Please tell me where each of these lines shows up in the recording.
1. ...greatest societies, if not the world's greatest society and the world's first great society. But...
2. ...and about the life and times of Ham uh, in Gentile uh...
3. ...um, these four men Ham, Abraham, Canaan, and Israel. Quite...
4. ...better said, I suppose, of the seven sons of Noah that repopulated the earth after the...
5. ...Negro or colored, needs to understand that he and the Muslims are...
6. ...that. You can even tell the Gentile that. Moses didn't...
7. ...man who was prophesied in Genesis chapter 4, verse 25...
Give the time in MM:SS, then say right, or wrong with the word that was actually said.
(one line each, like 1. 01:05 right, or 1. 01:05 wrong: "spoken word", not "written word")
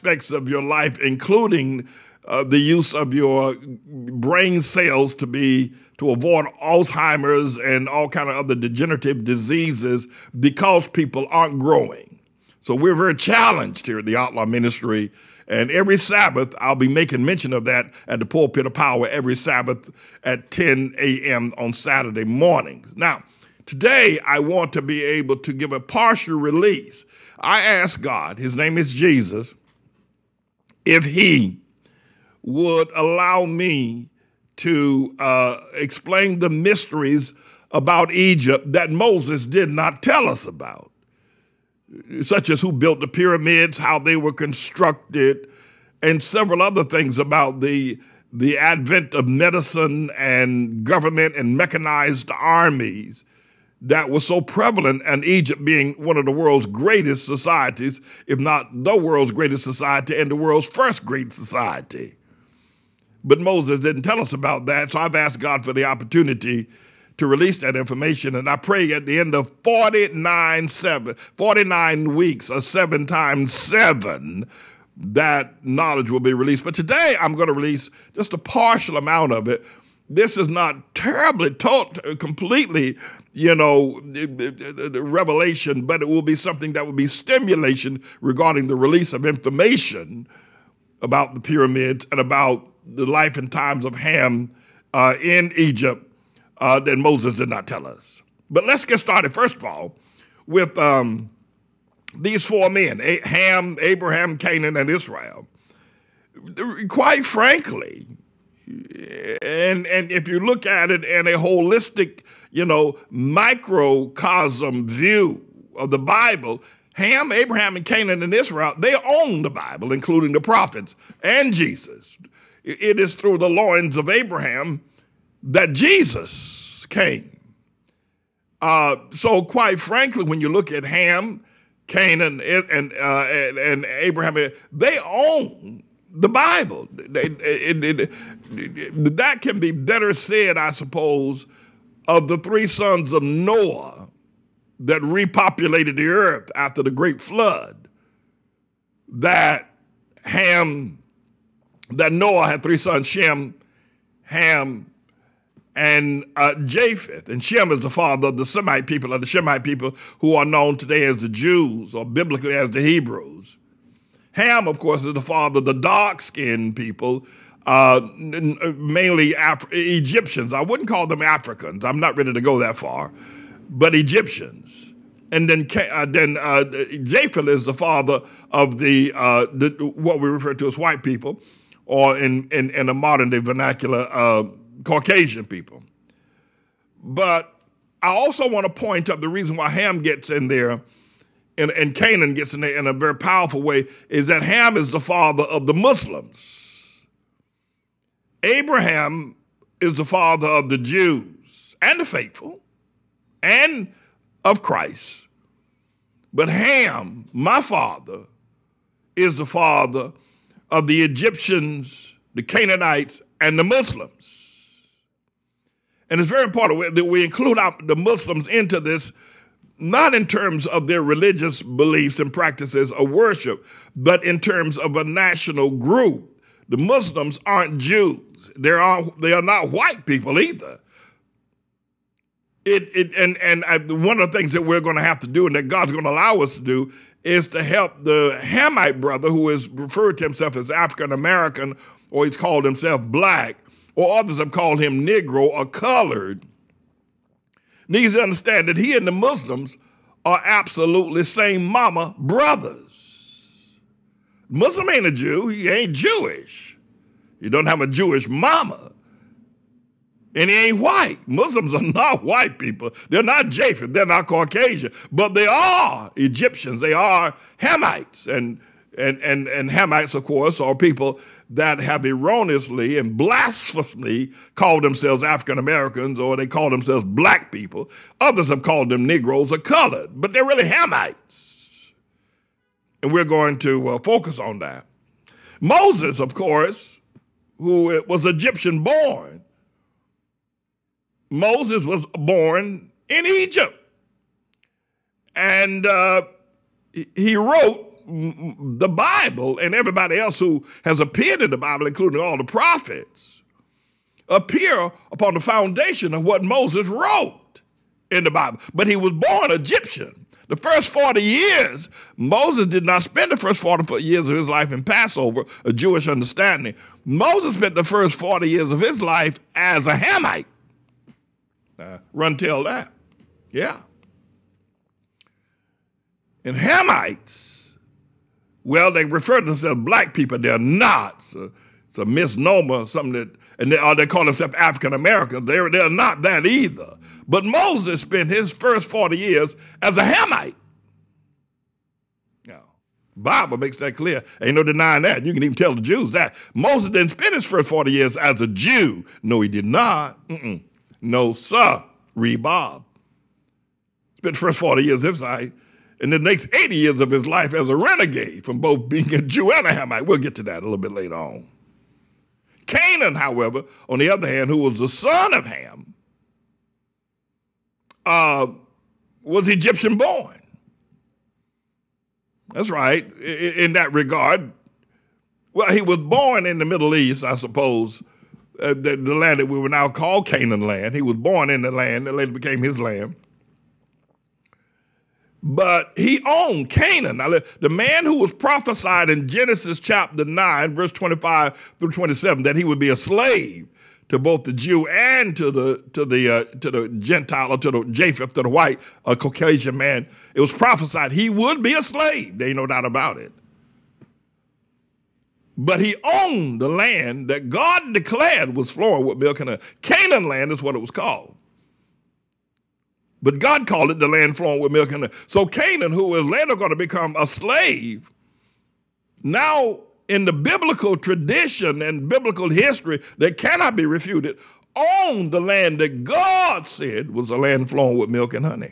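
1. 00:56 right
2. 01:32 wrong: "Egypt", not "Gentile"
3. 01:40 right
4. 02:19 wrong: "three", not "seven"
5. 04:05 right
6. 05:45 wrong: "Jews", not "Gentile"
7. 06:27 wrong: "9", not "4".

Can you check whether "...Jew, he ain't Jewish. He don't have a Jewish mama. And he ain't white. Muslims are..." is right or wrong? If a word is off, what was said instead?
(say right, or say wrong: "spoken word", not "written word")
right.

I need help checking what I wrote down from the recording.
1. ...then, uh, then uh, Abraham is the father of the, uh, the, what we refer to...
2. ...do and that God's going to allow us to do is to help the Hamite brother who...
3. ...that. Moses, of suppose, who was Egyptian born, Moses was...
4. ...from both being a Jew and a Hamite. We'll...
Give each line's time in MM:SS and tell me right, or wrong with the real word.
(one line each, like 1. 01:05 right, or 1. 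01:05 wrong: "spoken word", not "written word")
1. 02:55 wrong: "Japheth", not "Abraham"
2. 03:55 right
3. 04:44 wrong: "course", not "suppose"
4. 05:58 right.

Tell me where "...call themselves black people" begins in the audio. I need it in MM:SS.
04:36.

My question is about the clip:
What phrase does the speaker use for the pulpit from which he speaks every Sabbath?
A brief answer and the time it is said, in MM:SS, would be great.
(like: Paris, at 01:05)
pulpit of power, at 00:18.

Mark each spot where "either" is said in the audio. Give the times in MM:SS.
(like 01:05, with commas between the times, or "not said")
03:50, 05:36.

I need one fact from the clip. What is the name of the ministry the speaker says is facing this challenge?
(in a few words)
ATLAH Ministry.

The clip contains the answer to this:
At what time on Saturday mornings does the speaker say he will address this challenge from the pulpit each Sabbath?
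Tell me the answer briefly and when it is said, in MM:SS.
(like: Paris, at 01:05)
10 a.m., at 00:20.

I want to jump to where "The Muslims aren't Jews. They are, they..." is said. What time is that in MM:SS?
03:46.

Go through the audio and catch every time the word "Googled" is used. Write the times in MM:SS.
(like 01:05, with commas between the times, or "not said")
not said.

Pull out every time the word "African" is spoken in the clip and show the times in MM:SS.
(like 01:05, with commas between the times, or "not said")
02:51, 04:00, 04:35, 05:34.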